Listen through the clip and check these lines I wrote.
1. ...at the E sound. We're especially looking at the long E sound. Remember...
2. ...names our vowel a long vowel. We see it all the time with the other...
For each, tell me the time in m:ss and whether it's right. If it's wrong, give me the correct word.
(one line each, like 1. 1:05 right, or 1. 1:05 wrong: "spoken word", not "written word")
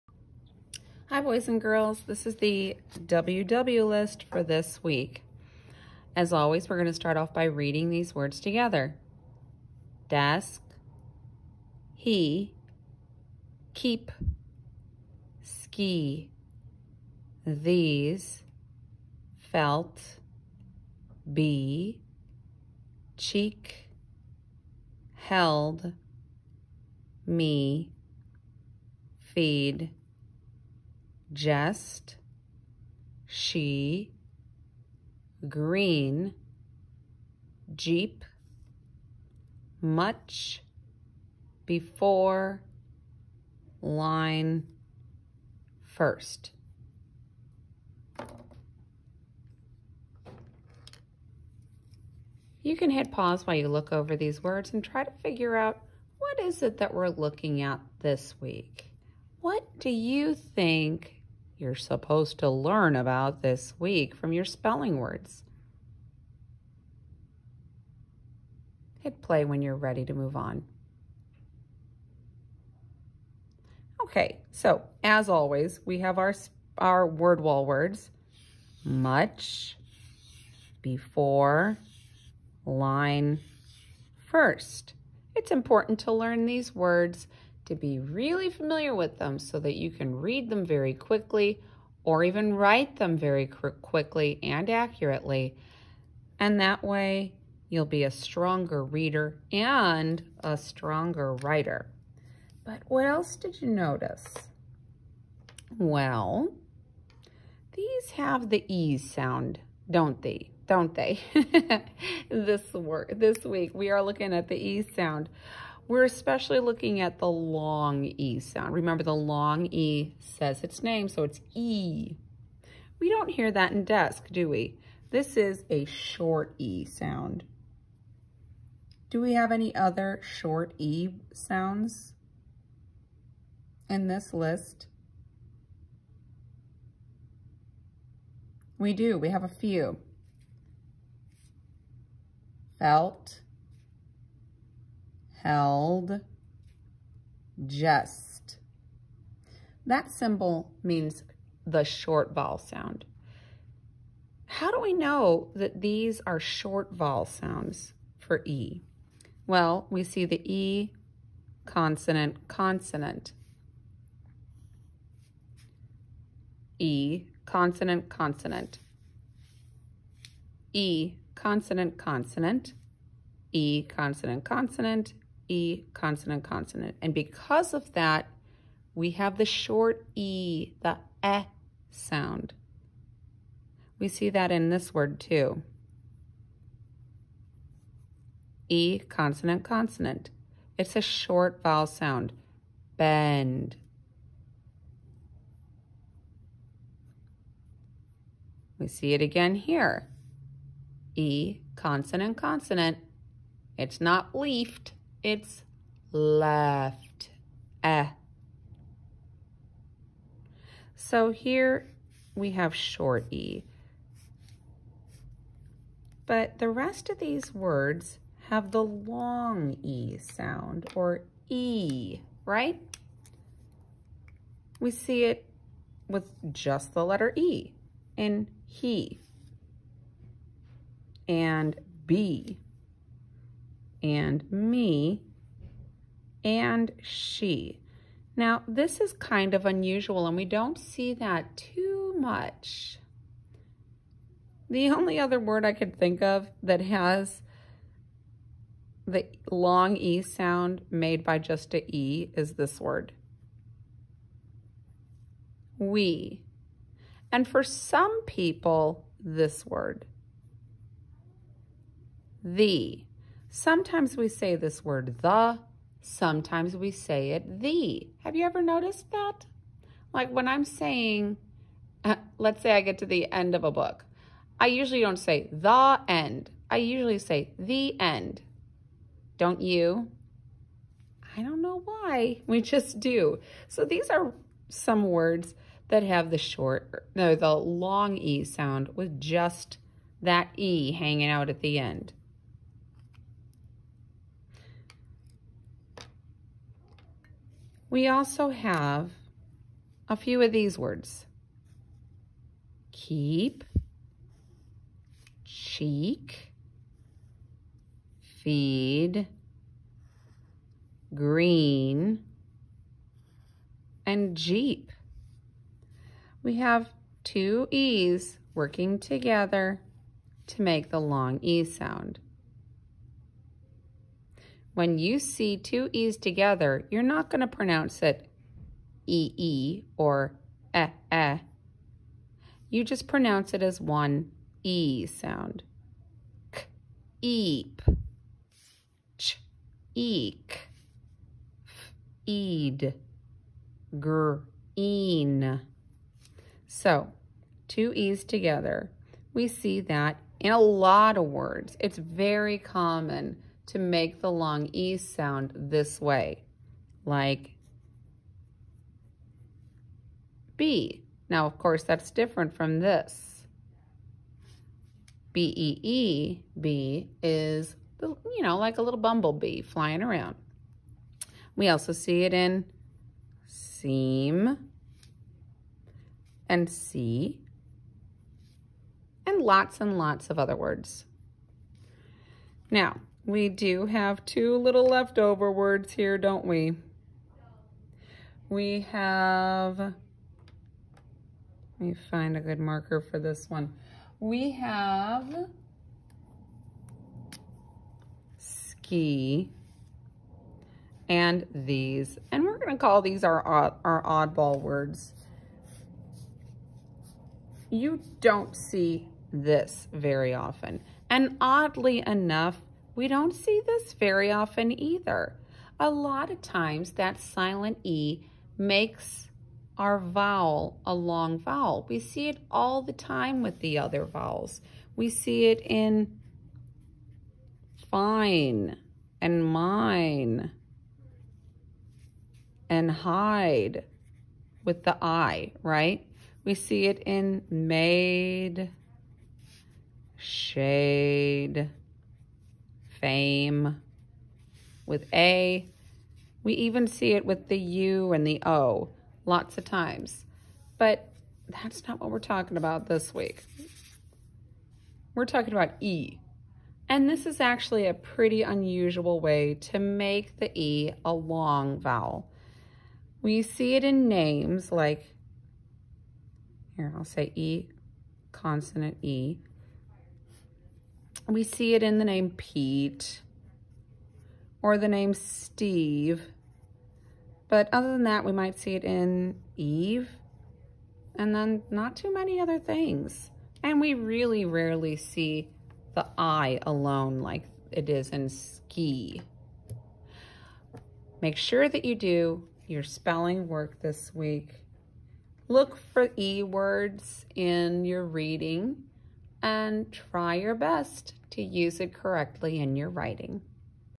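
1. 1:54 right
2. 6:58 wrong: "makes", not "names".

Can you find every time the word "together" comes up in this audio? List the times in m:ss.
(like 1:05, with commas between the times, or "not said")
0:08, 5:18, 5:26, 5:48.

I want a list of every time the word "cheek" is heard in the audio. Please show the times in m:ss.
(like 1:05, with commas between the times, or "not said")
0:23, 5:05.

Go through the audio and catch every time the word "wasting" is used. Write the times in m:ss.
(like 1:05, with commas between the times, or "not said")
not said.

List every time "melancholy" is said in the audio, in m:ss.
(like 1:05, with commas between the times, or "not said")
not said.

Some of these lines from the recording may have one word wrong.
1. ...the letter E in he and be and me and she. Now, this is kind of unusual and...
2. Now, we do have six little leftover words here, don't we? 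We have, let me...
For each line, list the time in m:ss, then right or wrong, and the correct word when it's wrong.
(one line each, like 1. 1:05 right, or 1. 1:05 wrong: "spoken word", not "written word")
1. 3:46 right
2. 6:22 wrong: "two", not "six".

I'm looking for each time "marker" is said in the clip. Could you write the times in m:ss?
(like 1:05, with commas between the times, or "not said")
6:32.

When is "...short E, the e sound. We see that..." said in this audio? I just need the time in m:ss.
2:59.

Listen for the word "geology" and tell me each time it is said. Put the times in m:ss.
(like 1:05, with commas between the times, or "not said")
not said.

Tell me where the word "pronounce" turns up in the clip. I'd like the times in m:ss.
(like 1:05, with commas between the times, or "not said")
5:27, 5:33.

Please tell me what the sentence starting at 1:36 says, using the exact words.
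And that way you'll be a stronger reader and a stronger writer.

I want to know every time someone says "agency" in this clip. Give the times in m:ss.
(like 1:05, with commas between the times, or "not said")
not said.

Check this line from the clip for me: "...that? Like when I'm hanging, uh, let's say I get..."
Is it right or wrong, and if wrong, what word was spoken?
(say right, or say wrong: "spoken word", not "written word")
wrong: "saying", not "hanging".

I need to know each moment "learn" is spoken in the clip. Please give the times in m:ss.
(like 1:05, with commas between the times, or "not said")
1:02, 1:26.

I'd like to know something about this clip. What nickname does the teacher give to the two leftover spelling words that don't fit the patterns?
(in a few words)
oddball words.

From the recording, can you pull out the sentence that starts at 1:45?
Well, these have the E sound, don't they?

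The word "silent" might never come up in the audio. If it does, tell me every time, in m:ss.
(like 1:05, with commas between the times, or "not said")
6:57.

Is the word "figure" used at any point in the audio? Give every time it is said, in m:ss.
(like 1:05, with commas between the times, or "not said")
0:55.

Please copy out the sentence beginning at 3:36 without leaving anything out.
But the rest of these words have the long E sound or E, right?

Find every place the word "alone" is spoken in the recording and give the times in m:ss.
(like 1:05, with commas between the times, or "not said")
8:06.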